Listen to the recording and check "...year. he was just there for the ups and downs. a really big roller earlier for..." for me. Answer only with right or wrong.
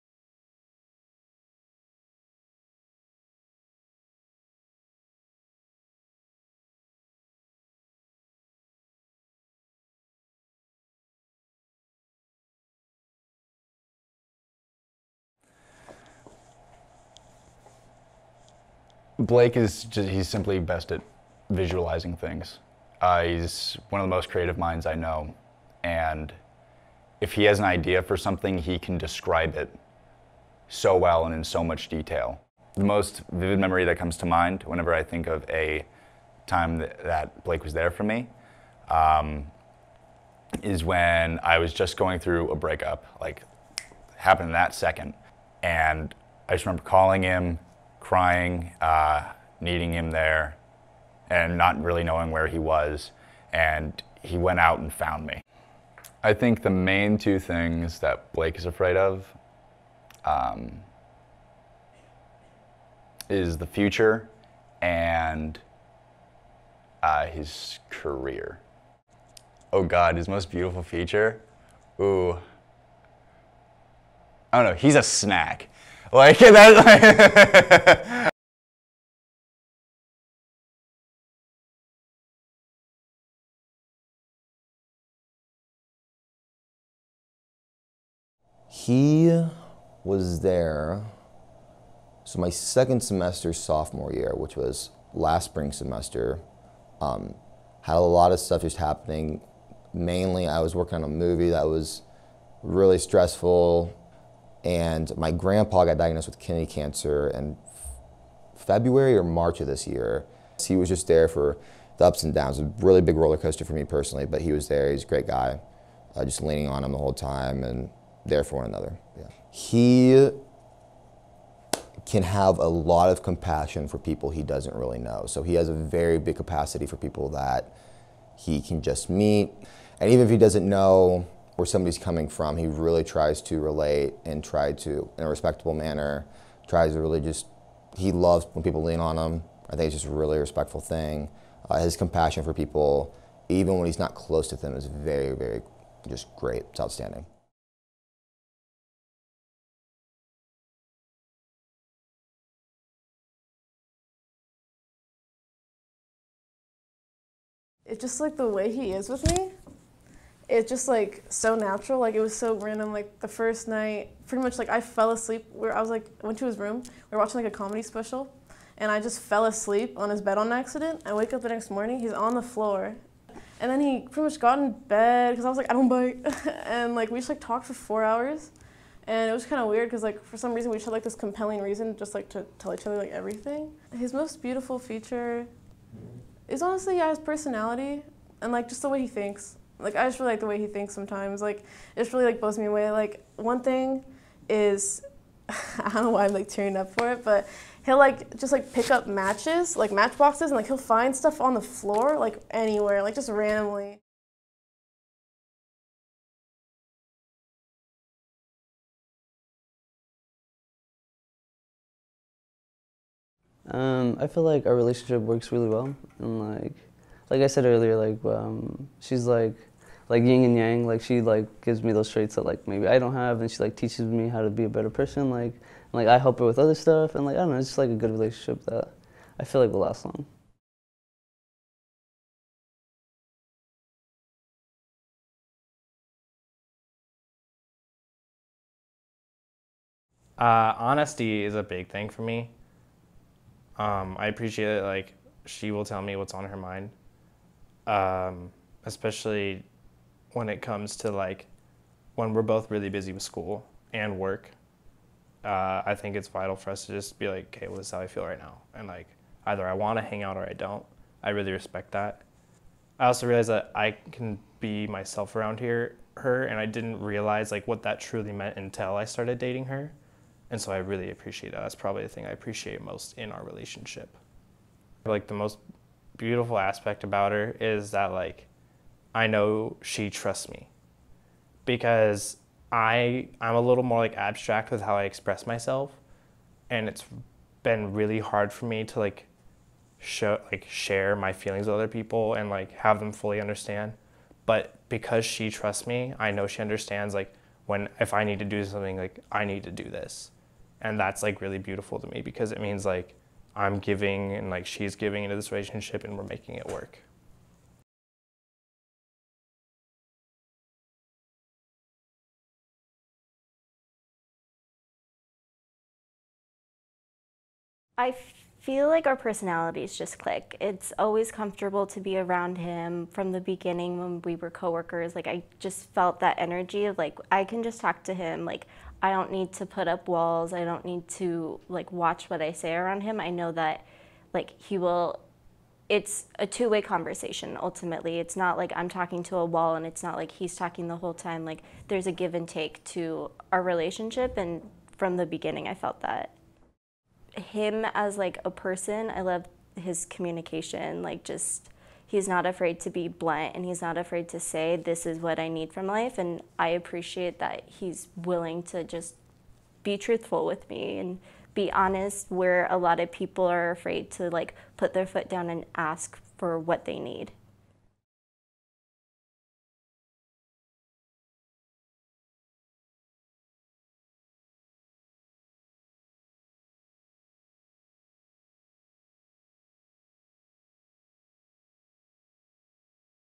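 wrong.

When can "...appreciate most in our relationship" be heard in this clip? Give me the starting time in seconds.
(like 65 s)
272 s.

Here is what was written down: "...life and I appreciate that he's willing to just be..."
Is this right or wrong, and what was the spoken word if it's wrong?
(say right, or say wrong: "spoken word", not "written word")
right.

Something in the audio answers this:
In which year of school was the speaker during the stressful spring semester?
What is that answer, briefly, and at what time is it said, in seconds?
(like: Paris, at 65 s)
Sophomore year, at 93 s.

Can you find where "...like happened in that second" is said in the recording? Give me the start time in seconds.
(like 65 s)
43 s.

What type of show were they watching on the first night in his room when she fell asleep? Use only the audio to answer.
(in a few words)
A comedy special.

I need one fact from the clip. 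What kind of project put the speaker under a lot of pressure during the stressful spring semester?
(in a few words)
A movie.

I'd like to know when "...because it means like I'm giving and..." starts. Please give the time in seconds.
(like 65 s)
302 s.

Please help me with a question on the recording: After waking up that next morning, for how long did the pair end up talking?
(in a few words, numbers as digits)
Four hours.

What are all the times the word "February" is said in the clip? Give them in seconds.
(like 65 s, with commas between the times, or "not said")
108 s.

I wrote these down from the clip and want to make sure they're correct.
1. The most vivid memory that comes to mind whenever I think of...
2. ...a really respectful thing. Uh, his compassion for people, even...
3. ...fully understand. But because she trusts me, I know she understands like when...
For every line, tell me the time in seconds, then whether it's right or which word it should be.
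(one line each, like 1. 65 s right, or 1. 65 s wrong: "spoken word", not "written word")
1. 32 s right
2. 140 s right
3. 293 s right.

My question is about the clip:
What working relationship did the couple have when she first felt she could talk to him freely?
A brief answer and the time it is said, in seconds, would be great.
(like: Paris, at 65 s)
Coworkers, at 324 s.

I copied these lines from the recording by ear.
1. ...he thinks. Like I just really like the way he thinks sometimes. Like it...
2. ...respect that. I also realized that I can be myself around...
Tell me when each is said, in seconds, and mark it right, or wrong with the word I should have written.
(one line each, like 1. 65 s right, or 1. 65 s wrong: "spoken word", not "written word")
1. 188 s right
2. 261 s right.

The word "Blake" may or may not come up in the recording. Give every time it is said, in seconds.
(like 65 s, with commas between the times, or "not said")
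19 s, 37 s, 58 s.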